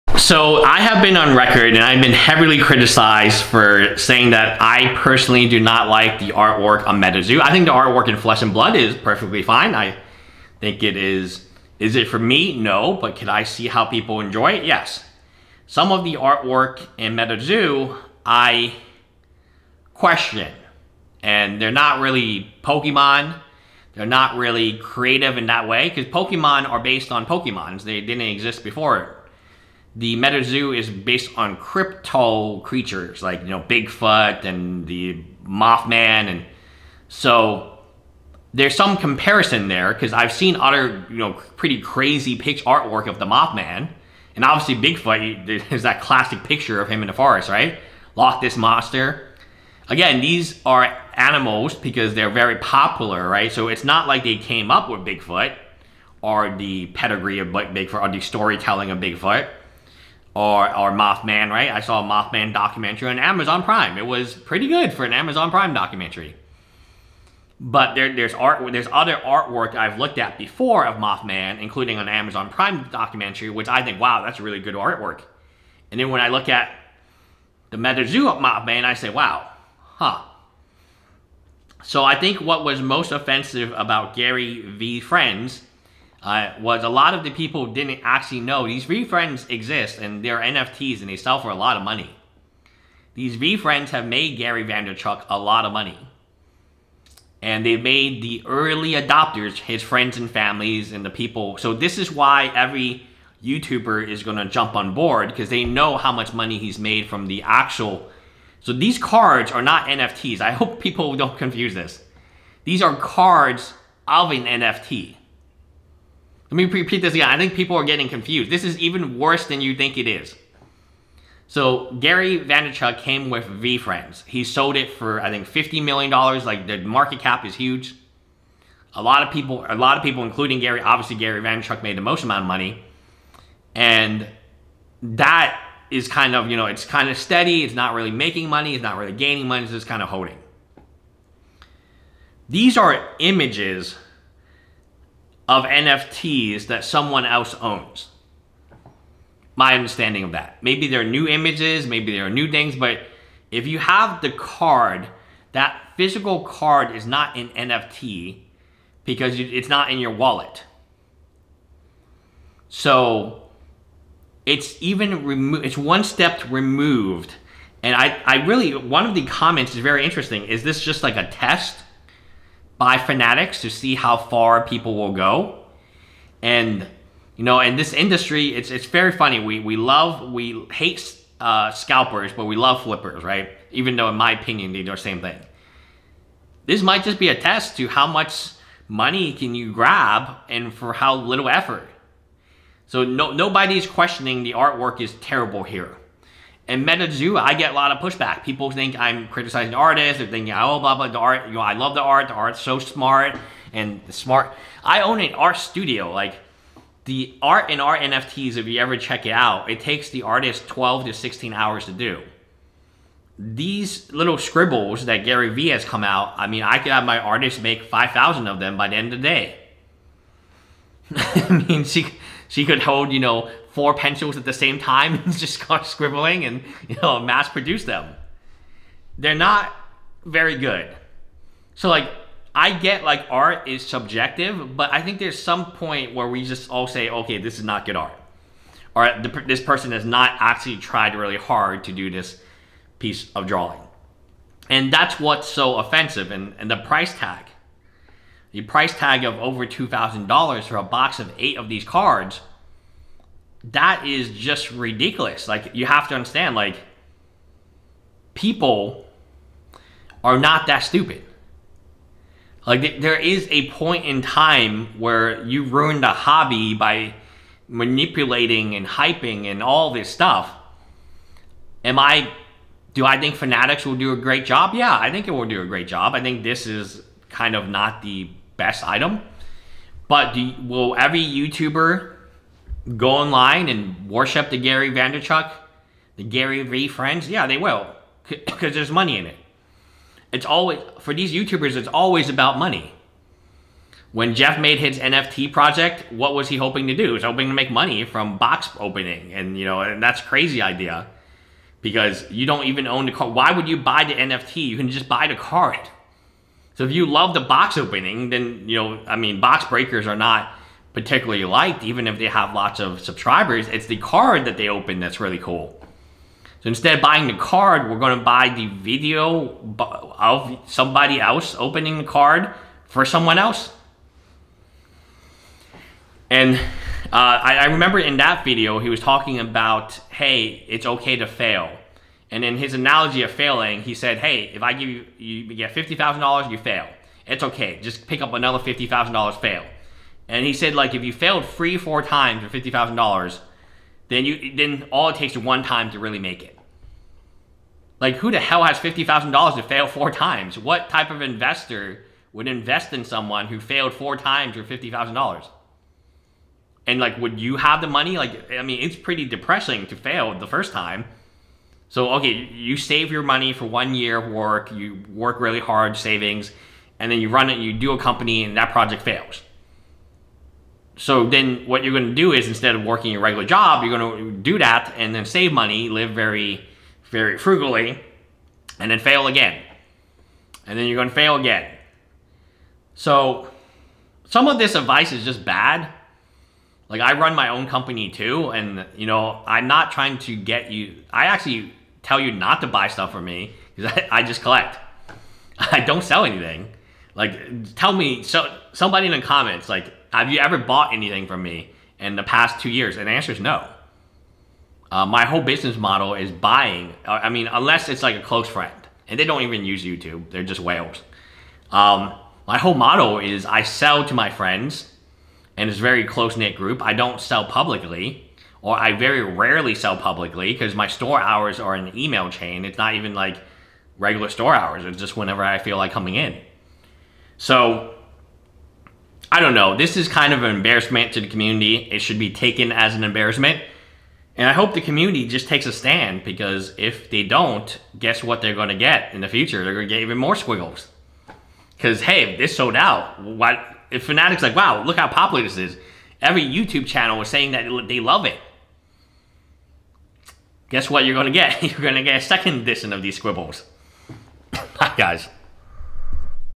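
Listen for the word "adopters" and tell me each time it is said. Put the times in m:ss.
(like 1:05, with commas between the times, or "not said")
1:38.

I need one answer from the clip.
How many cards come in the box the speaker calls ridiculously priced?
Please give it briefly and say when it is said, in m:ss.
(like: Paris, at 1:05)
8, at 4:11.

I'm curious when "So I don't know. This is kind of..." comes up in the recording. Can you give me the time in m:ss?
7:07.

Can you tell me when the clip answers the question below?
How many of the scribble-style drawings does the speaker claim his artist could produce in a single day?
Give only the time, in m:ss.
3:37.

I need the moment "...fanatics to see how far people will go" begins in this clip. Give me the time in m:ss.
2:52.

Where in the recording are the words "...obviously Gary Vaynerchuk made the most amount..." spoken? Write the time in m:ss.
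2:10.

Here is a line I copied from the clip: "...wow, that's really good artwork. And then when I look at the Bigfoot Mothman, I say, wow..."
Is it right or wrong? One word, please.
wrong.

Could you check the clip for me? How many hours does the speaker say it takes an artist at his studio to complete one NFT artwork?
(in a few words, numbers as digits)
12 to 16 hours.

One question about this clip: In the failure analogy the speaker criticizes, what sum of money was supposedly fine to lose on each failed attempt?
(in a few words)
$50,000.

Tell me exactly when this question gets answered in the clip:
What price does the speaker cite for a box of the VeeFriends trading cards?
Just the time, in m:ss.
4:09.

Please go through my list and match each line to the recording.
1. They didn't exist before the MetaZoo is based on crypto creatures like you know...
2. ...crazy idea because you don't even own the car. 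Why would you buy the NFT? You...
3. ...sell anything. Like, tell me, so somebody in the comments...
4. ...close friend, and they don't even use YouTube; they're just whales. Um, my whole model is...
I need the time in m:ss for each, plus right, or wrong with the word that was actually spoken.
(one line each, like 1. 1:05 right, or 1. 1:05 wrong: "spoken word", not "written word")
1. 0:27 right
2. 5:00 right
3. 6:36 right
4. 6:48 right.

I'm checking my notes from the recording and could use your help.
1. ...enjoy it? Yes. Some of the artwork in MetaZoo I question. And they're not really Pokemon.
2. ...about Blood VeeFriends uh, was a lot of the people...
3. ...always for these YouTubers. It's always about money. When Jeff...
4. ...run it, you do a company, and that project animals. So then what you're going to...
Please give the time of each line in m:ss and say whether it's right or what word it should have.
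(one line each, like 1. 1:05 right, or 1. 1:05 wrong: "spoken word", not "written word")
1. 0:14 right
2. 1:23 wrong: "Gary", not "Blood"
3. 4:50 right
4. 6:07 wrong: "fails", not "animals".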